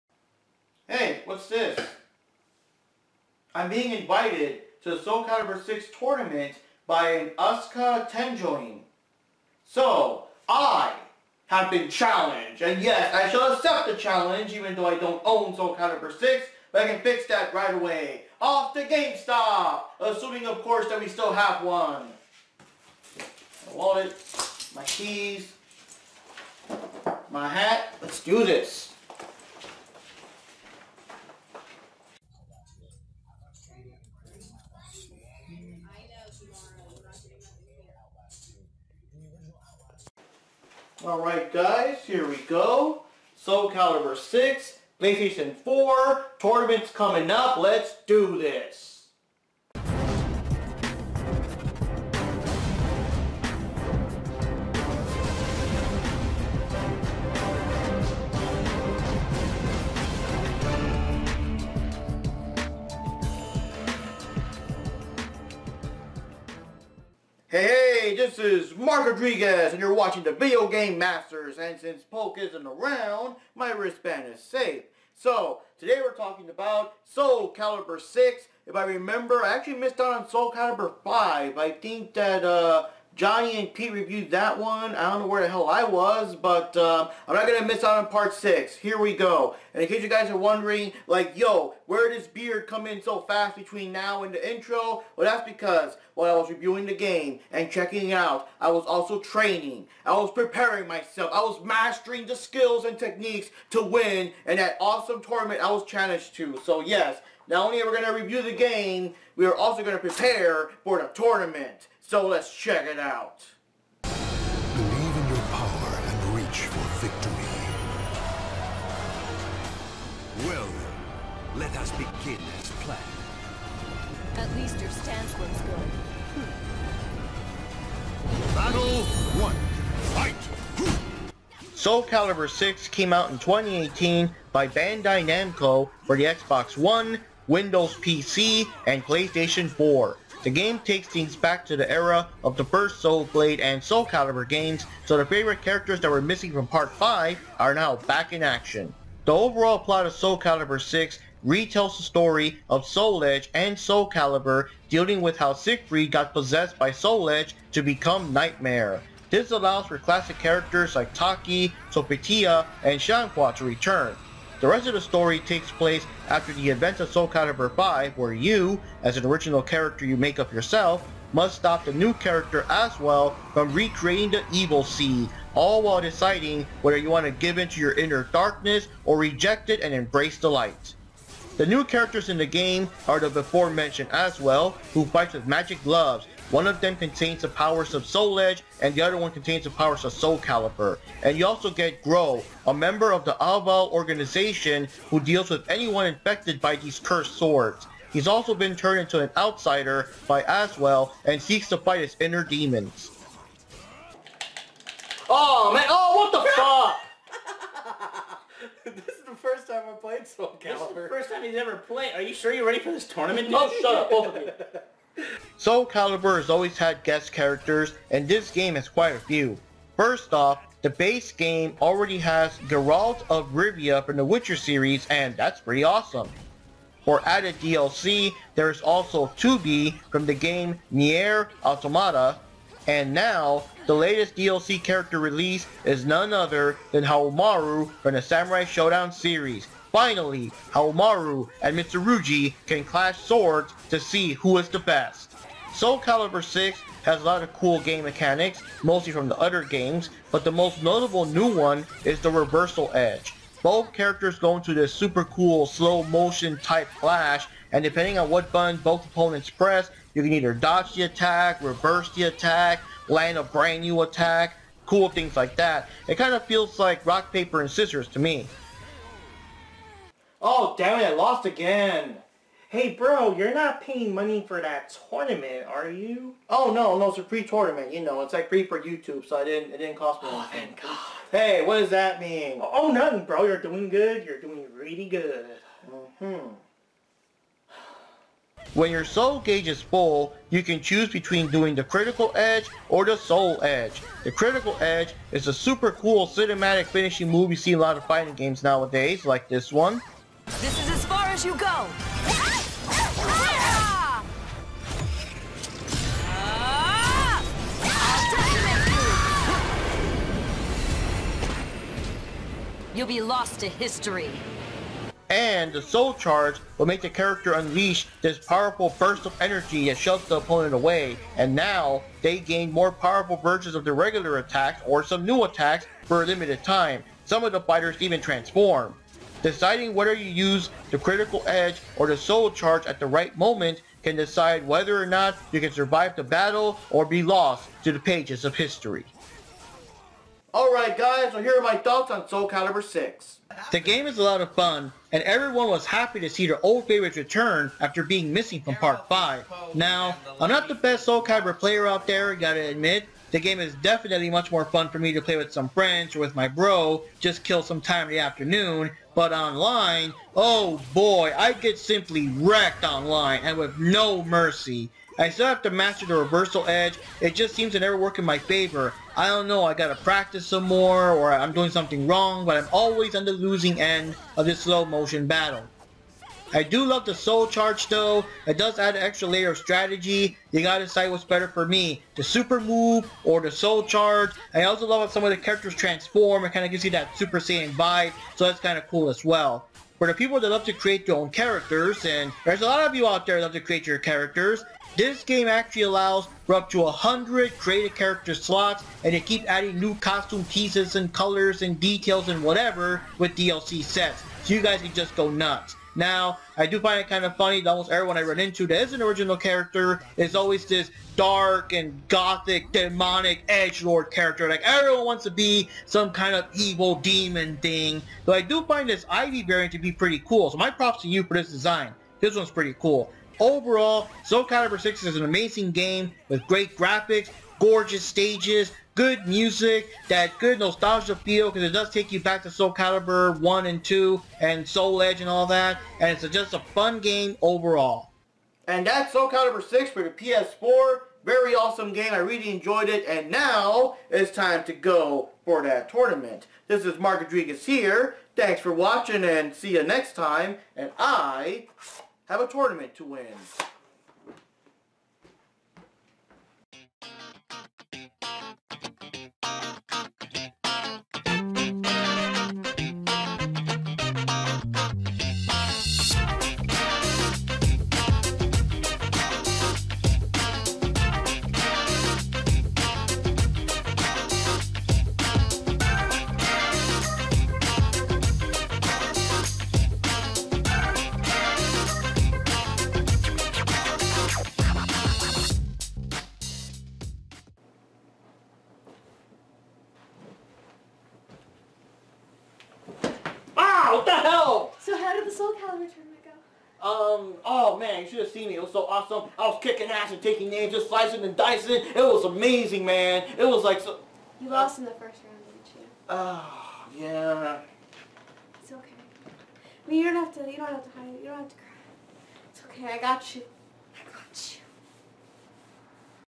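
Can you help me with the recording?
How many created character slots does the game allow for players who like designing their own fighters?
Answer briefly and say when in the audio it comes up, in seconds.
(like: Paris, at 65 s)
100, at 396 s.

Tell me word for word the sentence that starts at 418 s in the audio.
Though I do find this Ivy variant to be pretty cool, so my props to you for this design.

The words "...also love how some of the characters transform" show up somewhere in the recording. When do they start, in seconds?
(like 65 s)
384 s.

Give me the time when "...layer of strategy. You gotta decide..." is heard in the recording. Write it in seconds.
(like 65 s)
379 s.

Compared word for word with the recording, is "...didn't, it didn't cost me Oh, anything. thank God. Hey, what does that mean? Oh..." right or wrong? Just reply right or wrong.
right.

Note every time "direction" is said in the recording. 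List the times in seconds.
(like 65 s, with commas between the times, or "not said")
not said.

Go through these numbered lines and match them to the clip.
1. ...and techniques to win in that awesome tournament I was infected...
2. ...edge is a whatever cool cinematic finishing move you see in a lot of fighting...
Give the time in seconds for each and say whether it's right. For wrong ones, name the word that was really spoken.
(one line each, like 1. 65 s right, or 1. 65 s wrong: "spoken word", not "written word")
1. 102 s wrong: "challenged", not "infected"
2. 294 s wrong: "super", not "whatever".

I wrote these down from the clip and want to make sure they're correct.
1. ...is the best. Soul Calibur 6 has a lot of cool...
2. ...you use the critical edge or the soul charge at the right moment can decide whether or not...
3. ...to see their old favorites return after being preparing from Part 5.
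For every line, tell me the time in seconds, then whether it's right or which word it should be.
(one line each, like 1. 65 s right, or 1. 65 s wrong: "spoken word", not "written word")
1. 244 s right
2. 330 s right
3. 346 s wrong: "missing", not "preparing".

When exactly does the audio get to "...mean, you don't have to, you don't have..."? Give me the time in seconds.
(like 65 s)
509 s.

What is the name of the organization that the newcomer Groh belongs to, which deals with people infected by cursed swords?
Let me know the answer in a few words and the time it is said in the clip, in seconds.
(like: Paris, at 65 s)
Aval, at 193 s.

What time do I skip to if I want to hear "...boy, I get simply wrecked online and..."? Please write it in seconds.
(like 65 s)
360 s.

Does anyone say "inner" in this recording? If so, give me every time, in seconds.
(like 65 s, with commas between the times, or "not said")
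177 s, 202 s.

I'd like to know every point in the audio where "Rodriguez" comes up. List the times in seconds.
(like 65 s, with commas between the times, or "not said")
69 s, 447 s.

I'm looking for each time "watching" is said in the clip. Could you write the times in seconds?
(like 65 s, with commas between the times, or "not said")
69 s, 448 s.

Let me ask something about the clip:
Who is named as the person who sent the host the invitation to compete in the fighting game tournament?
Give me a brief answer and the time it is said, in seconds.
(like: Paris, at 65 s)
Asuka Tenjoin, at 7 s.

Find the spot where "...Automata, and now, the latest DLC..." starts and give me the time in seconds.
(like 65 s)
231 s.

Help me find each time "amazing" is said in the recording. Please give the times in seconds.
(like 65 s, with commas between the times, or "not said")
425 s, 502 s.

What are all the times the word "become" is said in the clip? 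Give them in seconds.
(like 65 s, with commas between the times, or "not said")
157 s.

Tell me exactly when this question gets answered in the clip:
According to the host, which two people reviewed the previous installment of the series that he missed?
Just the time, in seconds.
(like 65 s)
83 s.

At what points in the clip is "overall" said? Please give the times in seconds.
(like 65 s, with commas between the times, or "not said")
149 s, 423 s, 437 s.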